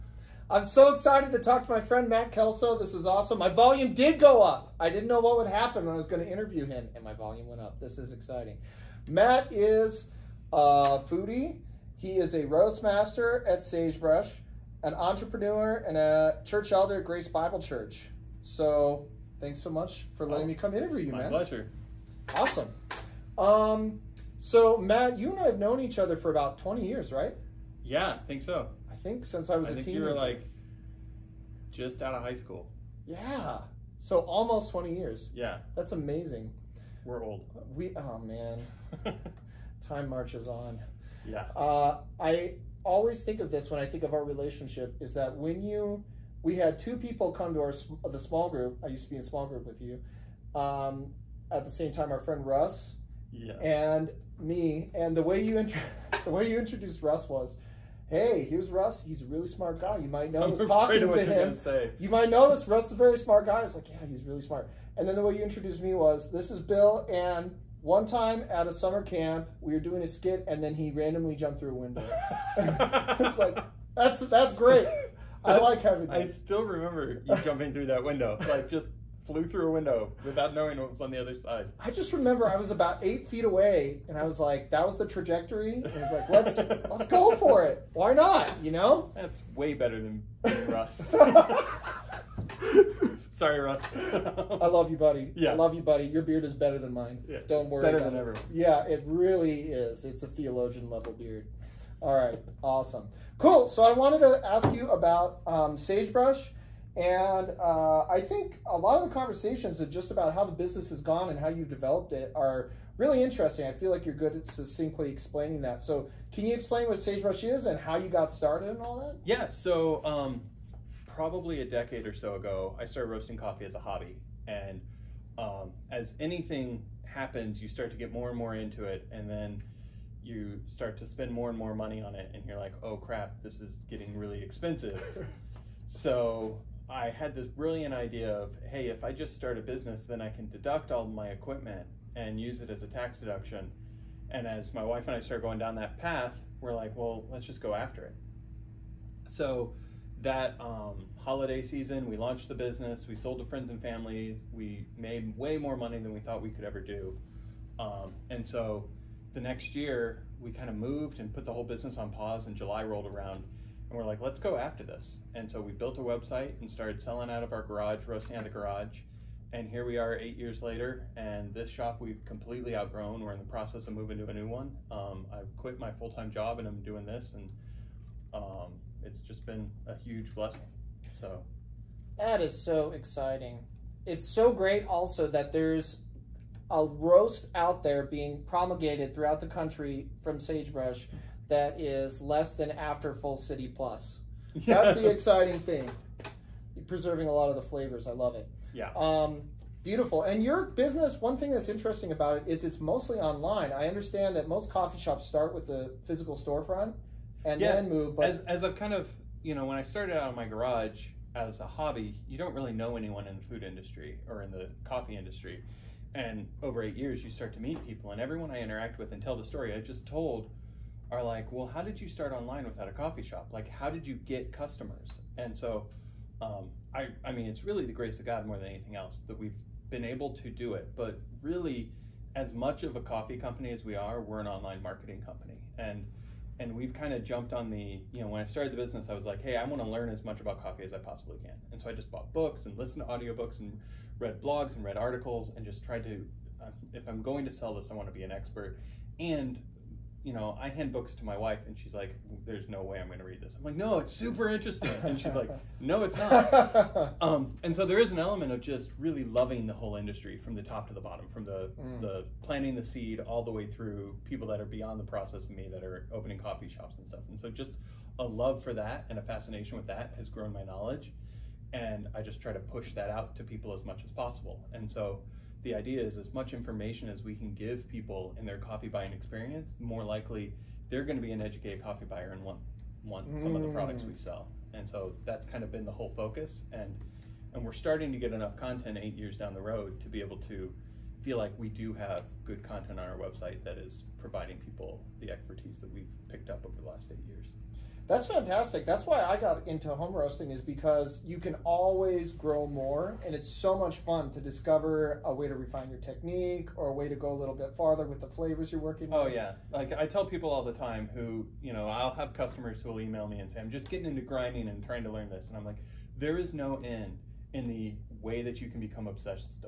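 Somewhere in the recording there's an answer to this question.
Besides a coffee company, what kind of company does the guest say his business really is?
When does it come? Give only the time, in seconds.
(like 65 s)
234 s.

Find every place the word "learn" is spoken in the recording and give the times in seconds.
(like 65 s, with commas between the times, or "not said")
239 s, 315 s.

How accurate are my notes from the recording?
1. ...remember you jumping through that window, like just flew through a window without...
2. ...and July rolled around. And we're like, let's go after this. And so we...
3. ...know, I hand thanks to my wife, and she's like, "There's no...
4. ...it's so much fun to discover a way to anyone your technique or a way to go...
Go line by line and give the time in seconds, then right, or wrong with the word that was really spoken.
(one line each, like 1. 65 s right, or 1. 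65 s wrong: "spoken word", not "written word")
1. 76 s right
2. 162 s right
3. 250 s wrong: "books", not "thanks"
4. 303 s wrong: "refine", not "anyone".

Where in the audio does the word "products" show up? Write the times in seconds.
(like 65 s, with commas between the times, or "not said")
283 s.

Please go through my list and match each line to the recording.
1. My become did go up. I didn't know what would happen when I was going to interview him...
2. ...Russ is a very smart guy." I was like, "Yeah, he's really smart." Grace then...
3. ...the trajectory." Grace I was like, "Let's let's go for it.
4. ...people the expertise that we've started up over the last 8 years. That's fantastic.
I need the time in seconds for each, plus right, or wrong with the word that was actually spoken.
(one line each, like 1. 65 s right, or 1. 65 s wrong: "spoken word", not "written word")
1. 3 s wrong: "volume", not "become"
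2. 62 s wrong: "And", not "Grace"
3. 84 s wrong: "And", not "Grace"
4. 294 s wrong: "picked", not "started".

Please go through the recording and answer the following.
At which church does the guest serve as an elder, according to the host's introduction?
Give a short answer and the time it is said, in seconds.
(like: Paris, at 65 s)
Grace Bible Church, at 17 s.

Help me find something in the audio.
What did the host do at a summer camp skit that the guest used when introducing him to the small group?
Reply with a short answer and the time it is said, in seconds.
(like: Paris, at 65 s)
Jumped through a window, at 71 s.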